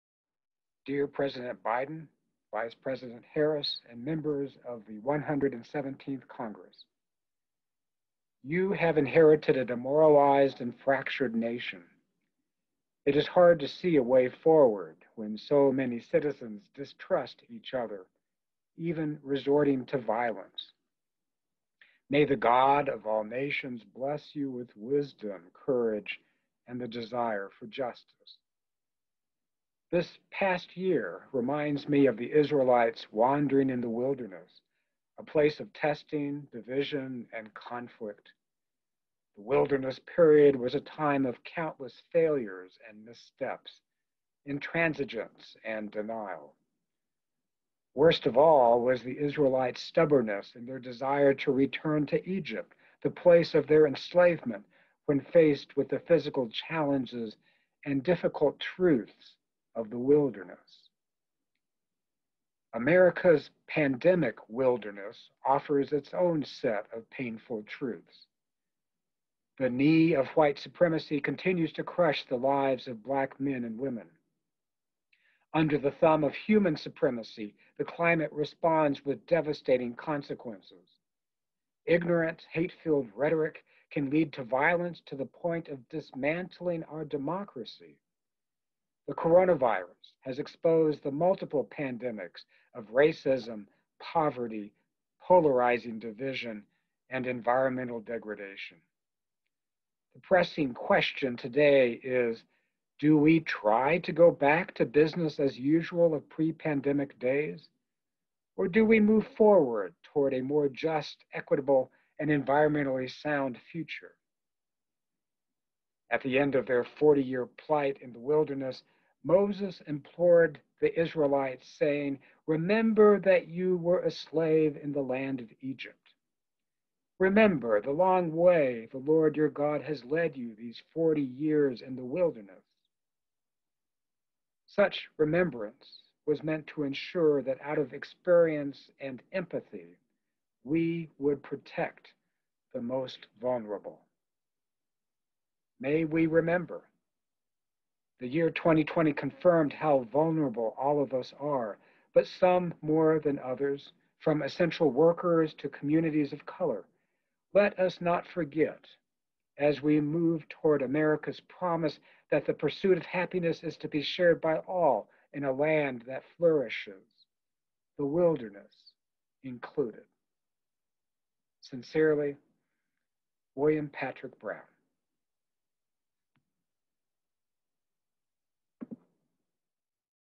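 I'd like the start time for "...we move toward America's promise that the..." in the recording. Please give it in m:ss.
2:39.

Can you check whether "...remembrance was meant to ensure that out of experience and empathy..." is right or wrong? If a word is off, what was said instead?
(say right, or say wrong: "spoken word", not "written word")
right.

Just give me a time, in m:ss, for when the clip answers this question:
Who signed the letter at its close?
2:53.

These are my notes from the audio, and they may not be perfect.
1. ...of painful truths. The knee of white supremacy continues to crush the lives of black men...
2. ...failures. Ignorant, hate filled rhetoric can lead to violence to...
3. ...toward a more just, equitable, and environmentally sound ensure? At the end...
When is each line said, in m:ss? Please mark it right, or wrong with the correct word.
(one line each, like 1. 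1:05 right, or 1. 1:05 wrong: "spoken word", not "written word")
1. 1:06 right
2. 1:19 wrong: "consequences", not "failures"
3. 1:50 wrong: "future", not "ensure".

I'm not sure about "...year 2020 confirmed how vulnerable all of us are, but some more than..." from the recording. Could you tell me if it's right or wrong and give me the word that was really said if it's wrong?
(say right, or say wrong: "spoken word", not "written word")
right.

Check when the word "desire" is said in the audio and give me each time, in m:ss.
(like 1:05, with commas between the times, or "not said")
0:26, 0:50.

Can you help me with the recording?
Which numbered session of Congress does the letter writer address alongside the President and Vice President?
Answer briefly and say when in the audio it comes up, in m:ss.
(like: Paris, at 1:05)
117th, at 0:05.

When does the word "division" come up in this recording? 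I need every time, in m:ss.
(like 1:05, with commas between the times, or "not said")
0:36, 1:35.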